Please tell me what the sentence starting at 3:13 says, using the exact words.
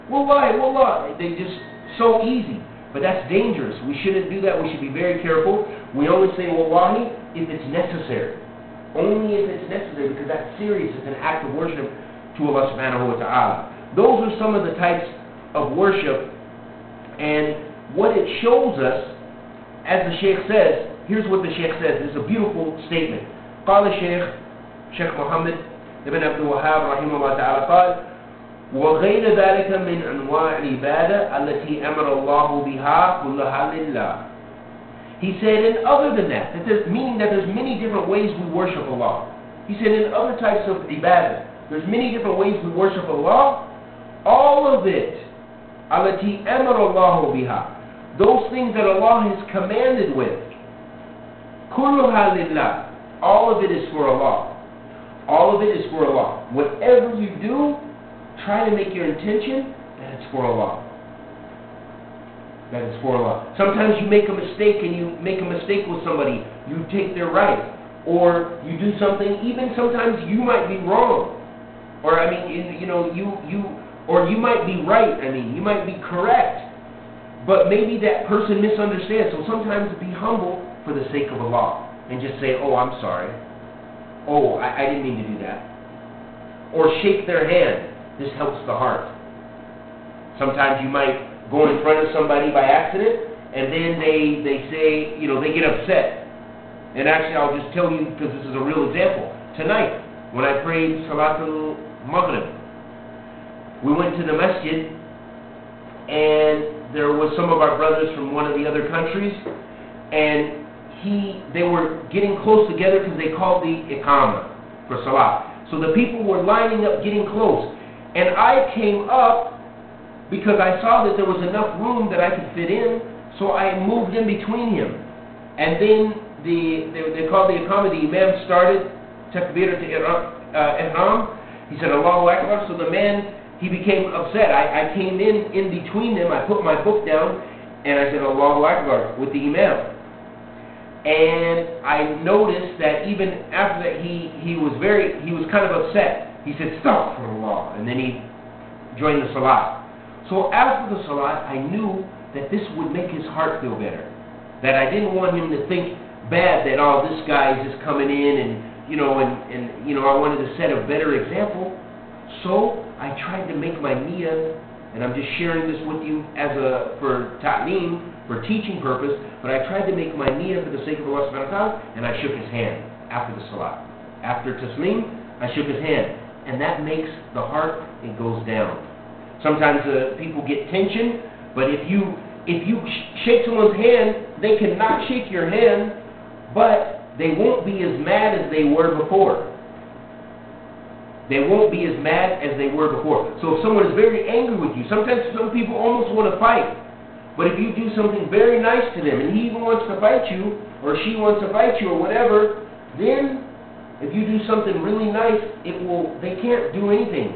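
So if someone is very angry with you, sometimes some people almost want to fight.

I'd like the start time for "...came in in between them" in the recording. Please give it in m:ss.
2:14.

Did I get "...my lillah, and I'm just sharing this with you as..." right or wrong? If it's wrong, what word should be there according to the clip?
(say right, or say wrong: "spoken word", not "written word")
wrong: "niyyah", not "lillah".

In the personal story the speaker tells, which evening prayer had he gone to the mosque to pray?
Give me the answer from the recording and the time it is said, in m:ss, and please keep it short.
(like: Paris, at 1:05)
Maghrib, at 1:42.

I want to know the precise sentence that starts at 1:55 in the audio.
So the people were lining up, getting close.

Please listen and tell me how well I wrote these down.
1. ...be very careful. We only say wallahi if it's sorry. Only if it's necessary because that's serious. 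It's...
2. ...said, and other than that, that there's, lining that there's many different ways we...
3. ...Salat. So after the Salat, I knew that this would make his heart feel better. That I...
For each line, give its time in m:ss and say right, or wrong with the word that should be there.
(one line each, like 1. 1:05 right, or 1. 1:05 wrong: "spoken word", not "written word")
1. 0:04 wrong: "necessary", not "sorry"
2. 0:35 wrong: "meaning", not "lining"
3. 2:29 right.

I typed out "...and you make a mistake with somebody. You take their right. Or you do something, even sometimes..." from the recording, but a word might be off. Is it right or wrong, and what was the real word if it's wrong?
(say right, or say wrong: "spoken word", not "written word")
right.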